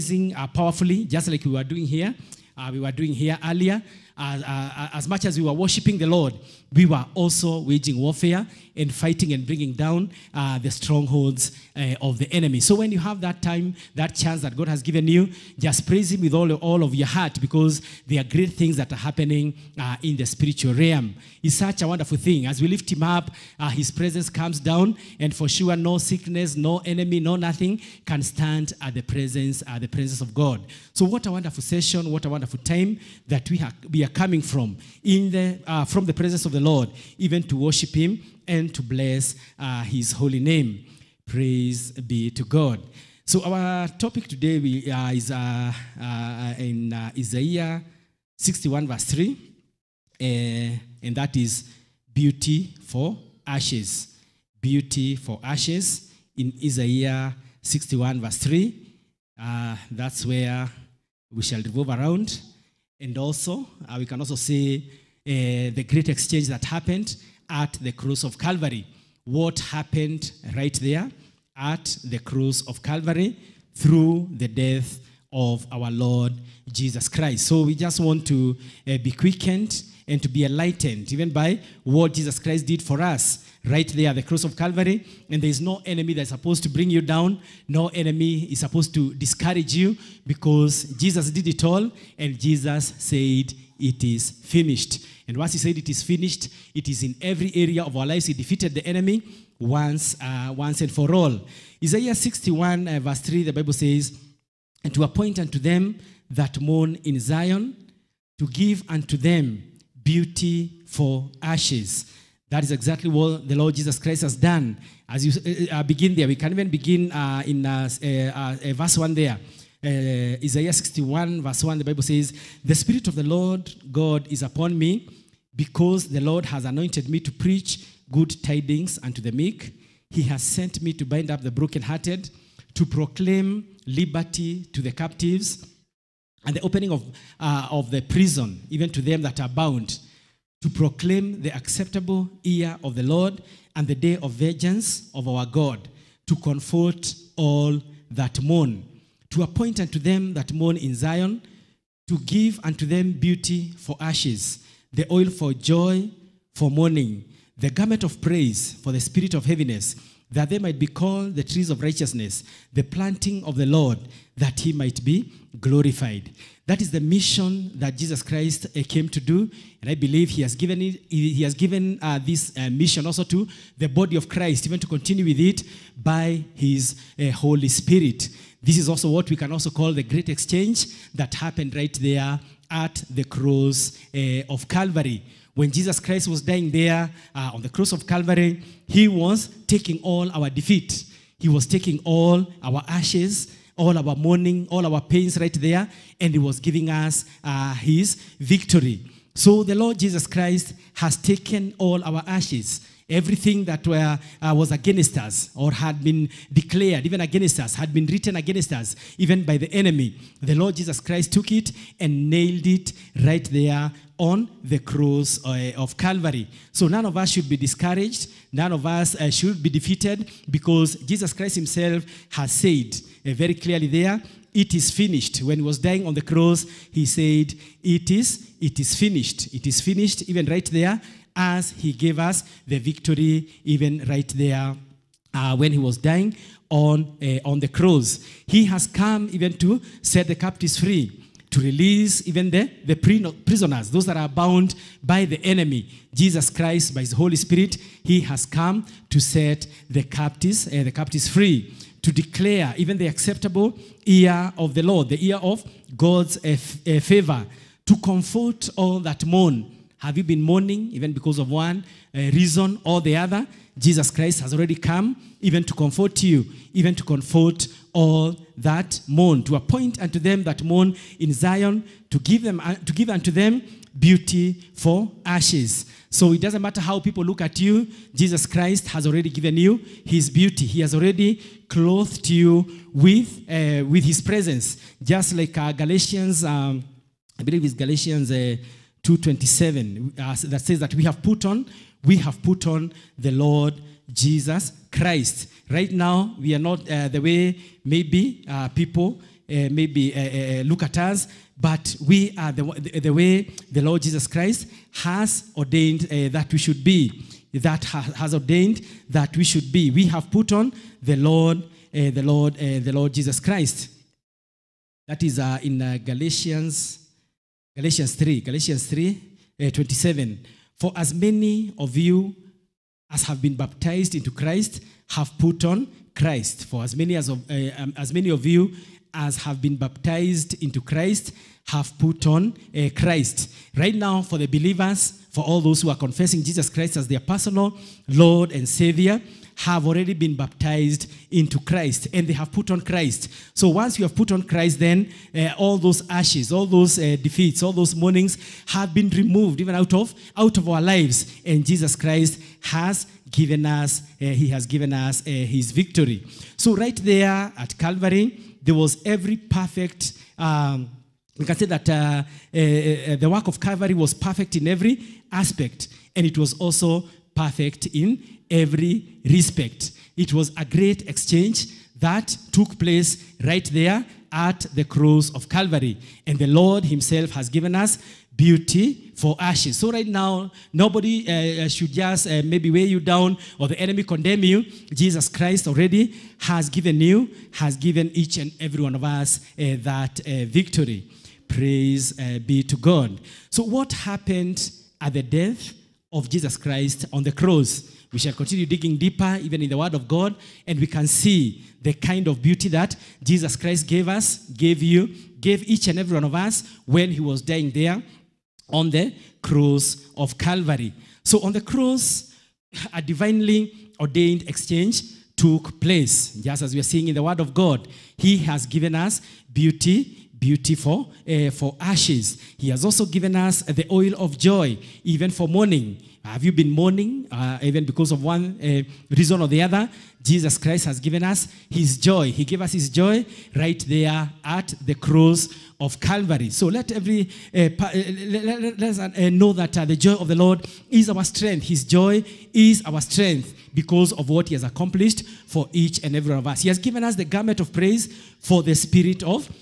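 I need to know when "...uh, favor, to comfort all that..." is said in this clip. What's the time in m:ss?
4:16.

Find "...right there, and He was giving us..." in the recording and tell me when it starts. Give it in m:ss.
3:15.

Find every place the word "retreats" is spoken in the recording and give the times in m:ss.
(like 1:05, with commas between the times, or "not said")
not said.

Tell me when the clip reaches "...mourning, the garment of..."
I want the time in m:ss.
2:36.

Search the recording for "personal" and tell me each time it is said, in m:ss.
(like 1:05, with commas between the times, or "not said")
5:37.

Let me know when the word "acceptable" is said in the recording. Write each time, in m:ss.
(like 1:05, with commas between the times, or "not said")
2:21, 4:13.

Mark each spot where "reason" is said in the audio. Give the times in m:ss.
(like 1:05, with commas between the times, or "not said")
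4:22, 7:09.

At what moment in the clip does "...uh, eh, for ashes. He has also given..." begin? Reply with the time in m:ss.
7:01.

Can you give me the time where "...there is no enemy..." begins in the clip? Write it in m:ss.
1:25.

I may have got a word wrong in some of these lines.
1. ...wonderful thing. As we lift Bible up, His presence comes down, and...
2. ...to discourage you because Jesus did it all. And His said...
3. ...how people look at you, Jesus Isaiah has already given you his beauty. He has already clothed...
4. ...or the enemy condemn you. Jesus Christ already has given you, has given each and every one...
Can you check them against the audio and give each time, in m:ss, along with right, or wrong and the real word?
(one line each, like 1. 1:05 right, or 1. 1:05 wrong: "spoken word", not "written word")
1. 0:21 wrong: "Him", not "Bible"
2. 1:28 wrong: "Jesus", not "His"
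3. 4:36 wrong: "Christ", not "Isaiah"
4. 6:23 right.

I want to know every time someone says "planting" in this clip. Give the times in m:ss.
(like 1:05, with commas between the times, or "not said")
2:42.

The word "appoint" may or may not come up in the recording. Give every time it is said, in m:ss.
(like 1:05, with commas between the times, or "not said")
1:45, 2:29, 4:29.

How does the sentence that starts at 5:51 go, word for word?
And Jesus Christ has given us uh, he has given us uh, his victory.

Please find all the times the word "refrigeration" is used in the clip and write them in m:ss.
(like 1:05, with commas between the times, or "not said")
not said.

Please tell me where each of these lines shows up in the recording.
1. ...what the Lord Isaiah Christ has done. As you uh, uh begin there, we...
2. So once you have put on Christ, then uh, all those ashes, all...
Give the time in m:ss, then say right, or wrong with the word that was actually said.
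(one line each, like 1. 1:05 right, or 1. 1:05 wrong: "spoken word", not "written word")
1. 1:53 wrong: "Jesus", not "Isaiah"
2. 5:43 right.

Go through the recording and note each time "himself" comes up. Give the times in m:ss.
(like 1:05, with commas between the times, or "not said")
3:41, 6:16.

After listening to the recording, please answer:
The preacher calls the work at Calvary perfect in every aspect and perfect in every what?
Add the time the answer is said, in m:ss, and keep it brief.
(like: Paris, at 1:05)
Respect, at 6:09.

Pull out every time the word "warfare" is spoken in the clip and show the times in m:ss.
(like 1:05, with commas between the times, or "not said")
0:07.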